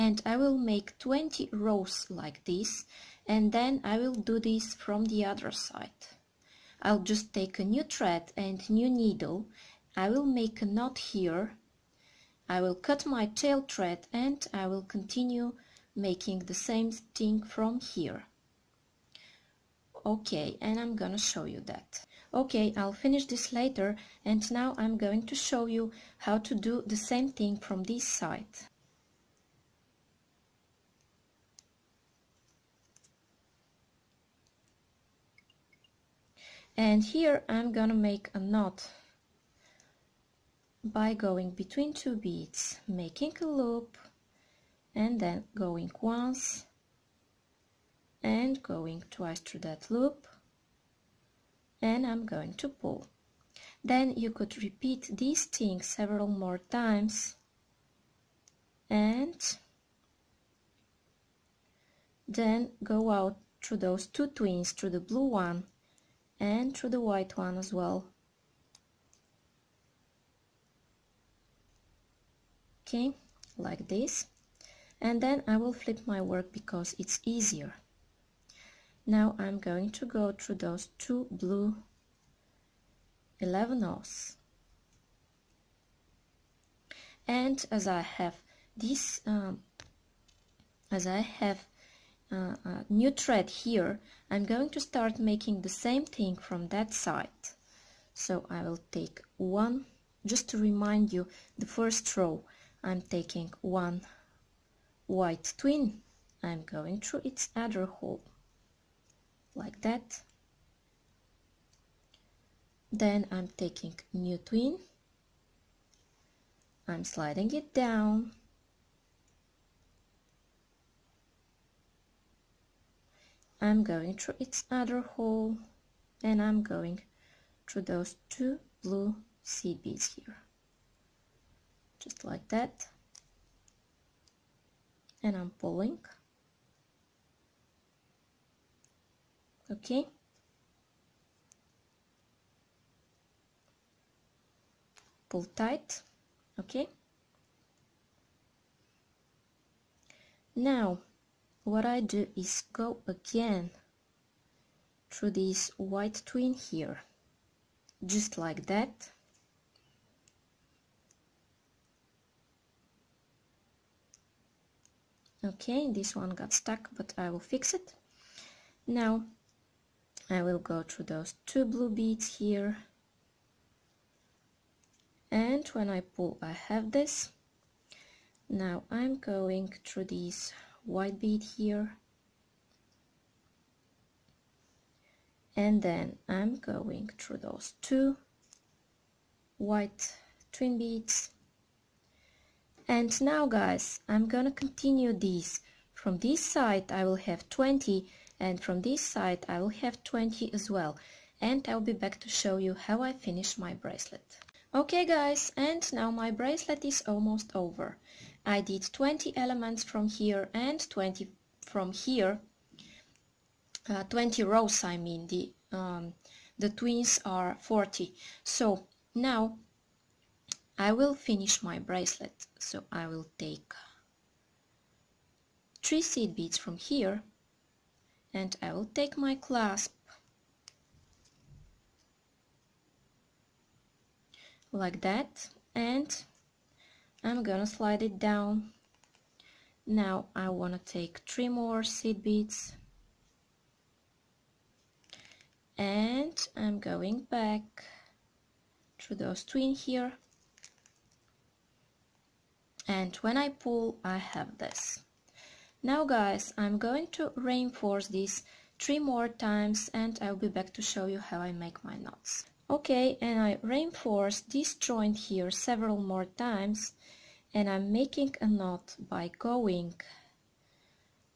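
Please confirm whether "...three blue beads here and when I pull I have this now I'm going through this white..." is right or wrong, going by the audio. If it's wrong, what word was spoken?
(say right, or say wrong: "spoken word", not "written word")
wrong: "two", not "three".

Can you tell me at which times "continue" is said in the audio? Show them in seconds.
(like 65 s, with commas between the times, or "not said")
14 s, 194 s.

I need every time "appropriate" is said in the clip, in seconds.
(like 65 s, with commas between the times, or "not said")
not said.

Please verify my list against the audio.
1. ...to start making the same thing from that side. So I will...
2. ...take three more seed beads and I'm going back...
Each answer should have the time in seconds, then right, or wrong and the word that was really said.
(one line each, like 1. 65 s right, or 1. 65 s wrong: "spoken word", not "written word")
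1. 94 s right
2. 240 s right.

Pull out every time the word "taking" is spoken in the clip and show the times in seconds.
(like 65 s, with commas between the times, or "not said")
103 s, 113 s.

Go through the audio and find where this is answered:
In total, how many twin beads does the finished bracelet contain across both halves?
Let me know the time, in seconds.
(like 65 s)
217 s.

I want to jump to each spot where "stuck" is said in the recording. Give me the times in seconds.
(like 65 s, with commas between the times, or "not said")
166 s.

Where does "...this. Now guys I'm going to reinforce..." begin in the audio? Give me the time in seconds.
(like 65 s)
254 s.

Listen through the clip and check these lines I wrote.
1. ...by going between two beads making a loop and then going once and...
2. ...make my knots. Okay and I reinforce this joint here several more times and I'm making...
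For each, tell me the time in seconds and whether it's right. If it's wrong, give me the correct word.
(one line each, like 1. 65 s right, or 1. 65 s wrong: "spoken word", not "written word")
1. 40 s right
2. 261 s right.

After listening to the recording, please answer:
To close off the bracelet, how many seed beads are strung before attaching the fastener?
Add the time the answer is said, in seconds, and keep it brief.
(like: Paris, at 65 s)
3, at 225 s.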